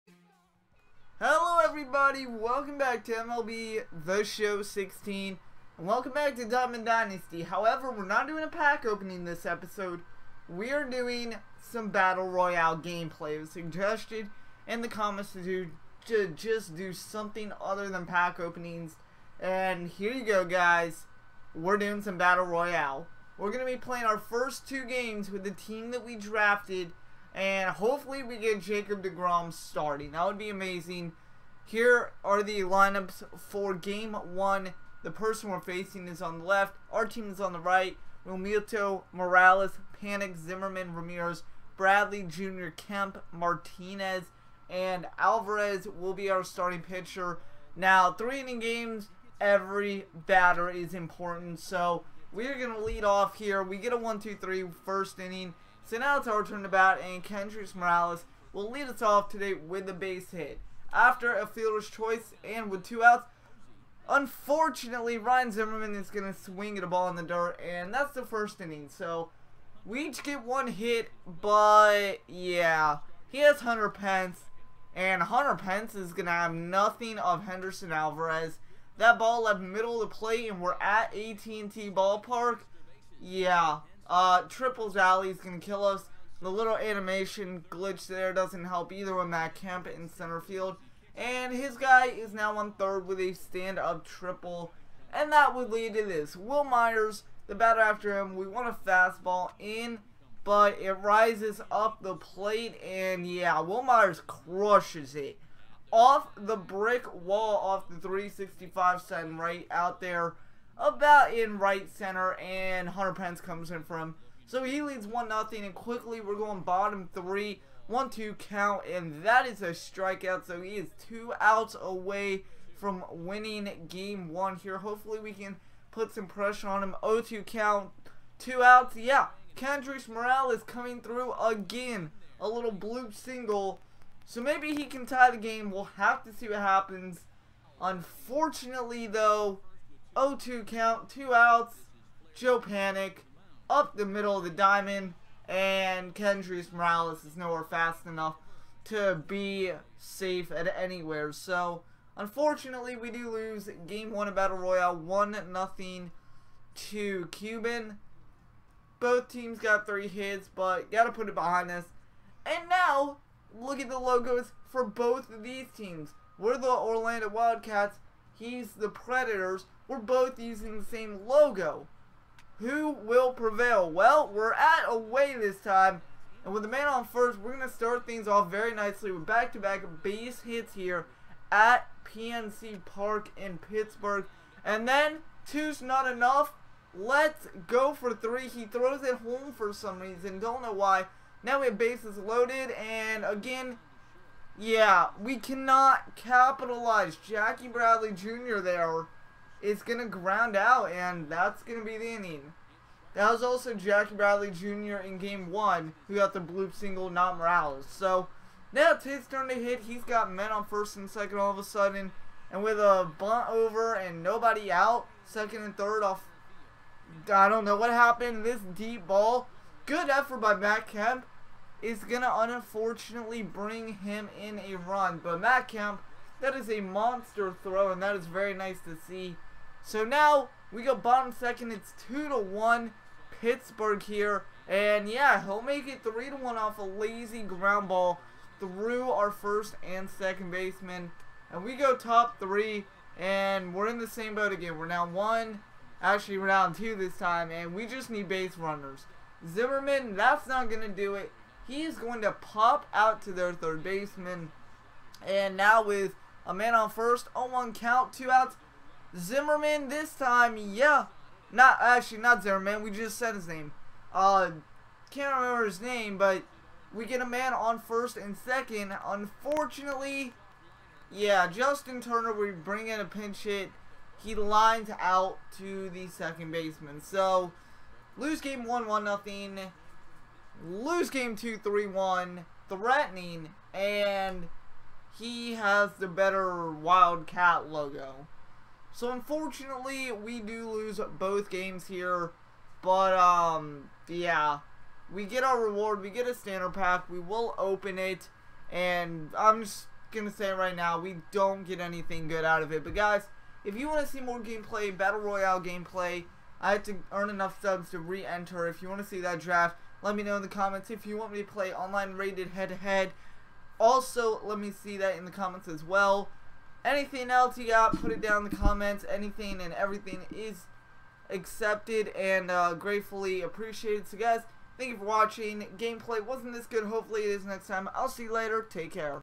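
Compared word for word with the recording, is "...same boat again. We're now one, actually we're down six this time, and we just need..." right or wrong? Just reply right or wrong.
wrong.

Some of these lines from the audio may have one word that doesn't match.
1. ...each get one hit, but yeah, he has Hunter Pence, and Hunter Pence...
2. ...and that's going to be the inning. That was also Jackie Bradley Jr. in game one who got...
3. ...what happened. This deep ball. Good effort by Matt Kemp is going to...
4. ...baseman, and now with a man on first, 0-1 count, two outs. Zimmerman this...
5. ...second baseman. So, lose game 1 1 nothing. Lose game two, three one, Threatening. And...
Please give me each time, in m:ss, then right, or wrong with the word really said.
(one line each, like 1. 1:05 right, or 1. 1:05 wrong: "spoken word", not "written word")
1. 1:10 right
2. 3:20 right
3. 3:37 right
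4. 4:13 right
5. 4:36 right.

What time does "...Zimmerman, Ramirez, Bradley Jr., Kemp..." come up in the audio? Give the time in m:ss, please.
0:40.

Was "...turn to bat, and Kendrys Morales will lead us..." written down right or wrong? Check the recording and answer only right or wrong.
right.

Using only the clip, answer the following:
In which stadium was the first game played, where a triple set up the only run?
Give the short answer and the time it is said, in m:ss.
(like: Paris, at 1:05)
AT&T Ballpark, at 1:21.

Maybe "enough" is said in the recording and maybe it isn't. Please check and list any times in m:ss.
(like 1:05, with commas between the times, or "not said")
2:28, 3:06, 5:07.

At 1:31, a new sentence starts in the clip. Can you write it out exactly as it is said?
And his guy is now on third with a stand-up triple.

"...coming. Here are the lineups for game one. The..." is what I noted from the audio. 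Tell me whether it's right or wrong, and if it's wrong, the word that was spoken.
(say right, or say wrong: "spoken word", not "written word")
wrong: "amazing", not "coming".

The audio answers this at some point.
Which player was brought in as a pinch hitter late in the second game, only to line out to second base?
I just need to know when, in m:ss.
4:31.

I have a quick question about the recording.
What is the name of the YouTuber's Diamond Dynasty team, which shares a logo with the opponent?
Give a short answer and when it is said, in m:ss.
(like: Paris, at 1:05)
Orlando Wildcats, at 2:46.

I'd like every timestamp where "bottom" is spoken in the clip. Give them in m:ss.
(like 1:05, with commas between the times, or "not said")
1:56, 3:50.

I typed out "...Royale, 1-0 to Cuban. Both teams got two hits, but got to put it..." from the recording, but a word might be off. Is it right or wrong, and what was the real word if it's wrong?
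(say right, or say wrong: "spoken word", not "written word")
wrong: "three", not "two".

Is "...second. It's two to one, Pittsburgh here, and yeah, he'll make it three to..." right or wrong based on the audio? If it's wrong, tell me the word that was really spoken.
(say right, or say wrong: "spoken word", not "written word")
right.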